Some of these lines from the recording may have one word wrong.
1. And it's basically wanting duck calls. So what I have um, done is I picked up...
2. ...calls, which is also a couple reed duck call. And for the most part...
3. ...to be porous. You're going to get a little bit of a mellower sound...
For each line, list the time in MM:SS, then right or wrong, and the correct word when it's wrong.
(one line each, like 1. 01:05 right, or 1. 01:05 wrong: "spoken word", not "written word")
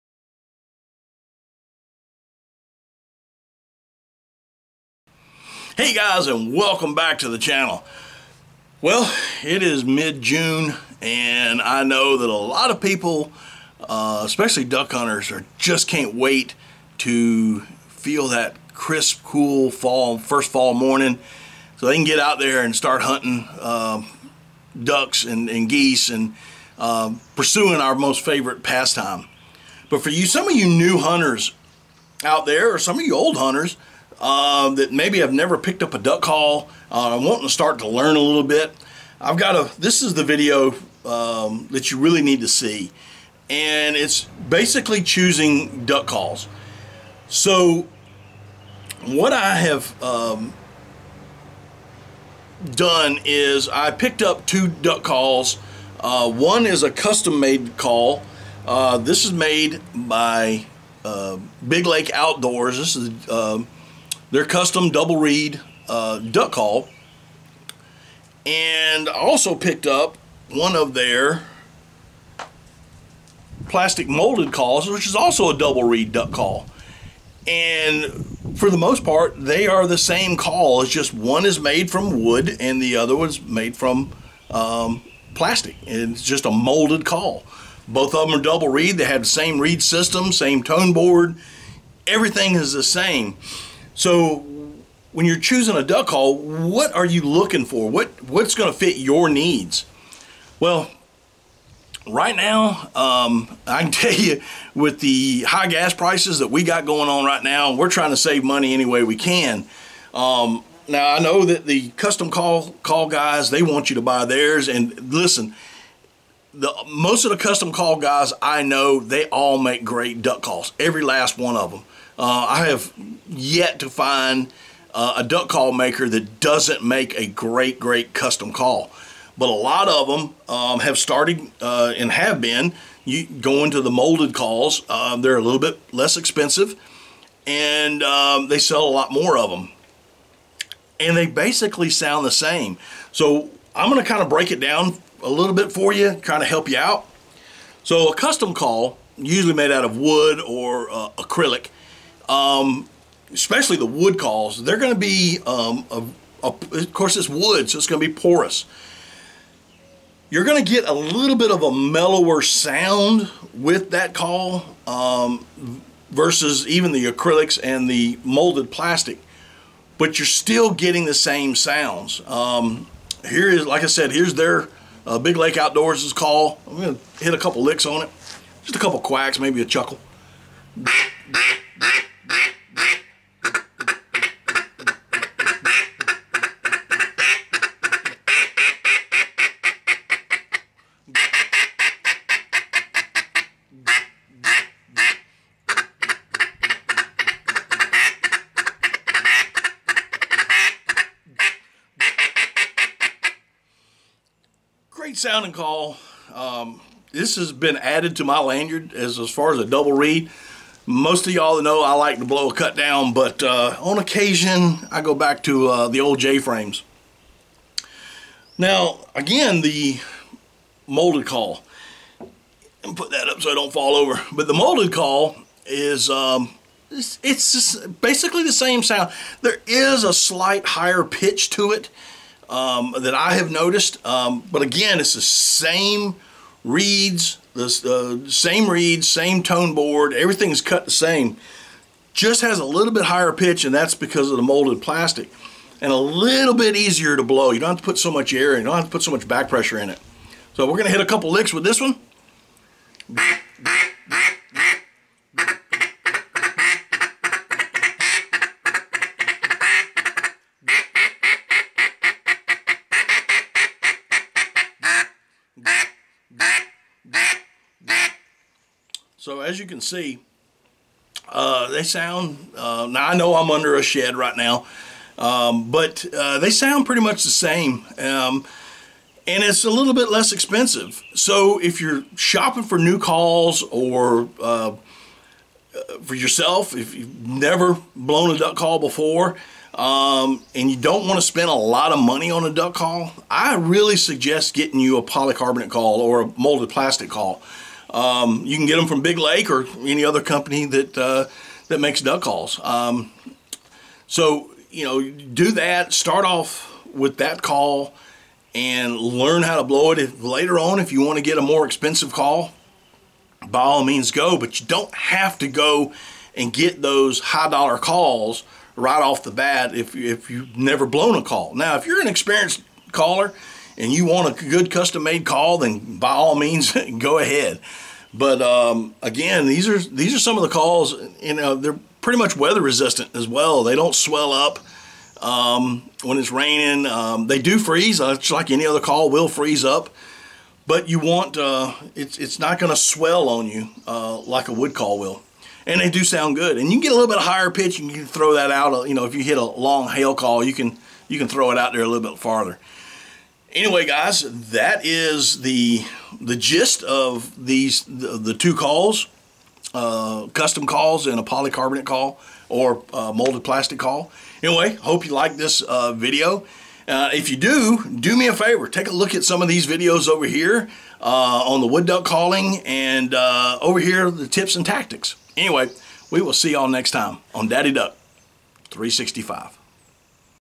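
1. 00:43 wrong: "choosing", not "wanting"
2. 01:14 wrong: "double", not "couple"
3. 02:38 right.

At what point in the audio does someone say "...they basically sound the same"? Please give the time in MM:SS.
02:21.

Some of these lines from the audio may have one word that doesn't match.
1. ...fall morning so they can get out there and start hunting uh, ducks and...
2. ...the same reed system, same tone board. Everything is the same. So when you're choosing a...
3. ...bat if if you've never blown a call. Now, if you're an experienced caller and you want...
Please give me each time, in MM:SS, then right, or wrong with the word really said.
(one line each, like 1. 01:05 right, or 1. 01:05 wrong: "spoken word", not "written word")
1. 00:20 right
2. 01:29 right
3. 05:19 right.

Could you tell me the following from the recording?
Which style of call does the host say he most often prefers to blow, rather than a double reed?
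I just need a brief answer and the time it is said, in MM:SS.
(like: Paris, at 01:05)
cut down, at 03:32.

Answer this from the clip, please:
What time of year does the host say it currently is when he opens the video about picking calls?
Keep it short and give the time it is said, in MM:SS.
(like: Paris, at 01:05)
mid-June, at 00:09.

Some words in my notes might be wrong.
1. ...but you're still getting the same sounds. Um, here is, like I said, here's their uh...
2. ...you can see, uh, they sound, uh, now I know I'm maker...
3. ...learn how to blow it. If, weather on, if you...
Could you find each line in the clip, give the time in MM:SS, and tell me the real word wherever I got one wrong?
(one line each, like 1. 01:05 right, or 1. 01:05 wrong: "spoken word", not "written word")
1. 02:49 right
2. 04:29 wrong: "under", not "maker"
3. 05:08 wrong: "later", not "weather".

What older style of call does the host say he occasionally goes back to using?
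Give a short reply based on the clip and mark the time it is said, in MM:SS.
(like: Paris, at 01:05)
J-frames, at 03:36.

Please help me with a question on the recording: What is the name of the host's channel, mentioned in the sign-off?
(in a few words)
Daddy Duck 365.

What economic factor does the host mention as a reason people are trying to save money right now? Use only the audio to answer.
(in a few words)
high gas prices.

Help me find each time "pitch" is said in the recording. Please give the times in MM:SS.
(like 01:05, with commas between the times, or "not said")
03:51, 04:03, 05:47.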